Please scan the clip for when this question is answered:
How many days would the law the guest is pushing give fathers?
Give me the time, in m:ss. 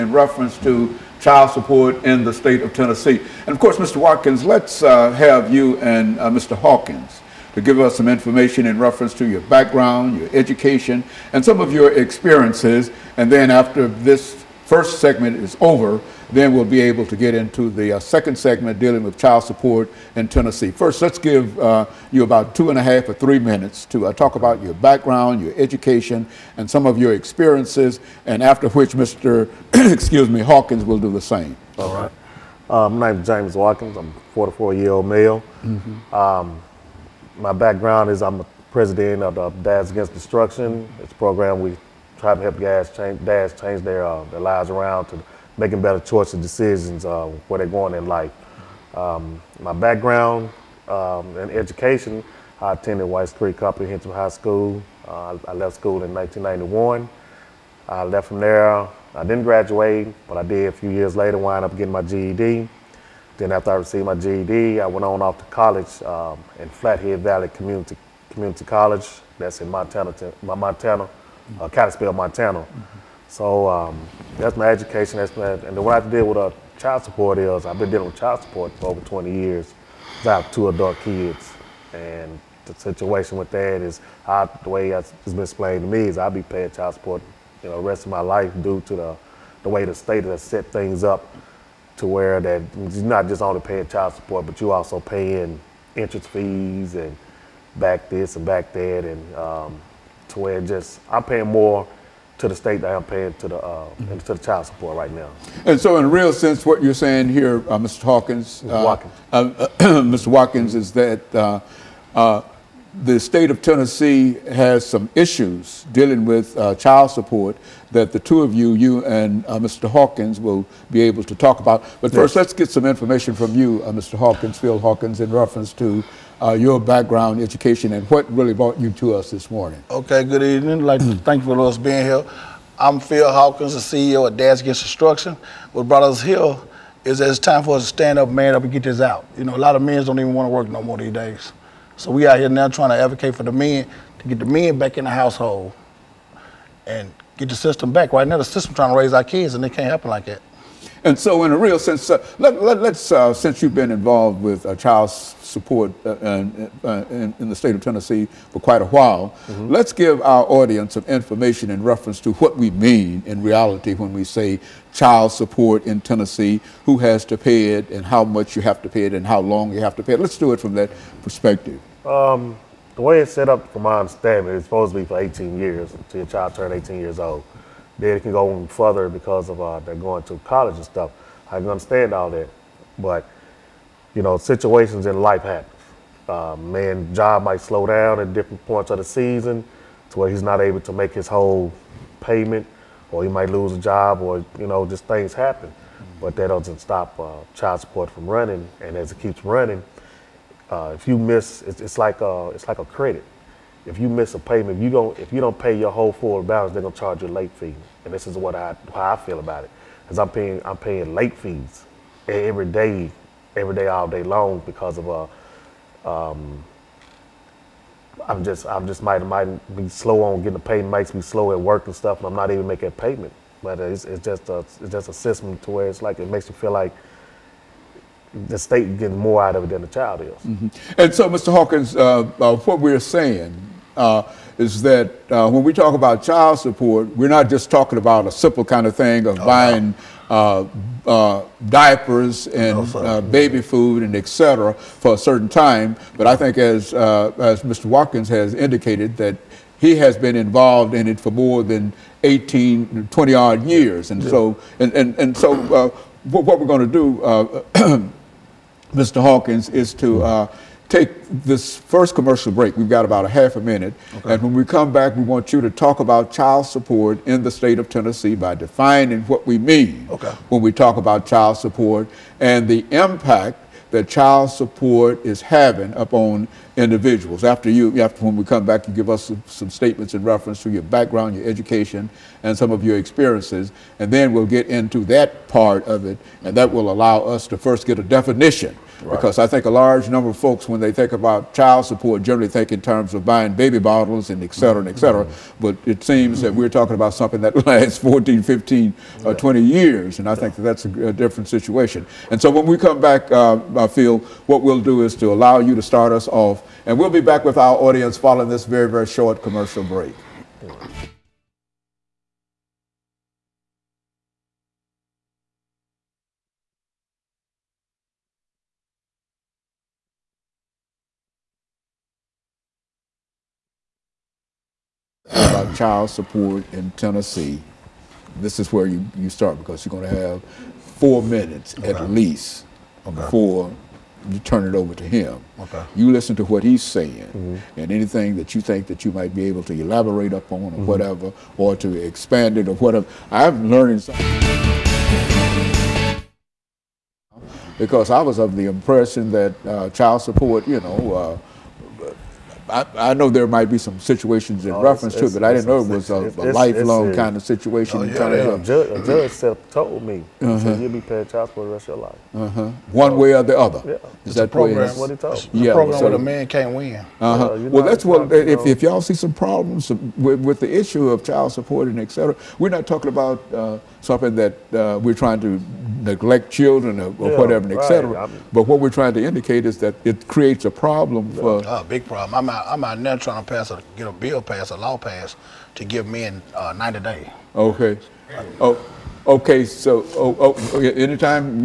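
6:26.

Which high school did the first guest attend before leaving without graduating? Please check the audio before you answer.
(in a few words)
White Creek Comprehensive High School.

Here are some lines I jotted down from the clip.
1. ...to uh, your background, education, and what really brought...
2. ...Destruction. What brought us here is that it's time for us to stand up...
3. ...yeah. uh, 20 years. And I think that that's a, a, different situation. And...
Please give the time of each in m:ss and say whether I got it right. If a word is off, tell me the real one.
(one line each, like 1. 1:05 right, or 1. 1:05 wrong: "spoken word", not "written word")
1. 2:05 right
2. 2:14 right
3. 4:59 right.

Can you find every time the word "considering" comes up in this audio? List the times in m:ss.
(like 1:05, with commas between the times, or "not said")
not said.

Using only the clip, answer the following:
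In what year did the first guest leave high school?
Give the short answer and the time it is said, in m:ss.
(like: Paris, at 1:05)
1991, at 0:56.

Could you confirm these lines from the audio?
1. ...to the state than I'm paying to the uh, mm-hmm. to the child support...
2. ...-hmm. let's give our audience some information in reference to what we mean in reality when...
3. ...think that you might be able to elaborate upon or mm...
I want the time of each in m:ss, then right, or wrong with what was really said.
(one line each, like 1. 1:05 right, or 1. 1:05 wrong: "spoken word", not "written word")
1. 1:42 right
2. 2:39 right
3. 5:38 right.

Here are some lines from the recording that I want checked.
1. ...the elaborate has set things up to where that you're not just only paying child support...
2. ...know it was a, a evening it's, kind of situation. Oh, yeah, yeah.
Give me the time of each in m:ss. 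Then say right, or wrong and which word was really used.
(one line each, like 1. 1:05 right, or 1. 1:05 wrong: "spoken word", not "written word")
1. 1:29 wrong: "state", not "elaborate"
2. 5:55 wrong: "lifelong", not "evening".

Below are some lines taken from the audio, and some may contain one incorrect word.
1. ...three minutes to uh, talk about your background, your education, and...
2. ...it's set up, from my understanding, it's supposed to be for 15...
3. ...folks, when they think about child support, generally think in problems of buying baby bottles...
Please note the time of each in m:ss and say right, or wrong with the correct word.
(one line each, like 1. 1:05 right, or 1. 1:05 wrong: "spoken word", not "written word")
1. 0:23 right
2. 2:53 wrong: "18", not "15"
3. 4:50 wrong: "terms", not "problems".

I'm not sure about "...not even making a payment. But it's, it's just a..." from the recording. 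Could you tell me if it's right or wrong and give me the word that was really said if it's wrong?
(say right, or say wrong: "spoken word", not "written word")
right.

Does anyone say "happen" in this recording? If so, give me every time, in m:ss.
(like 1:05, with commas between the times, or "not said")
2:29, 3:05, 3:15.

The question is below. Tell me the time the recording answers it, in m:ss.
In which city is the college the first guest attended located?
1:11.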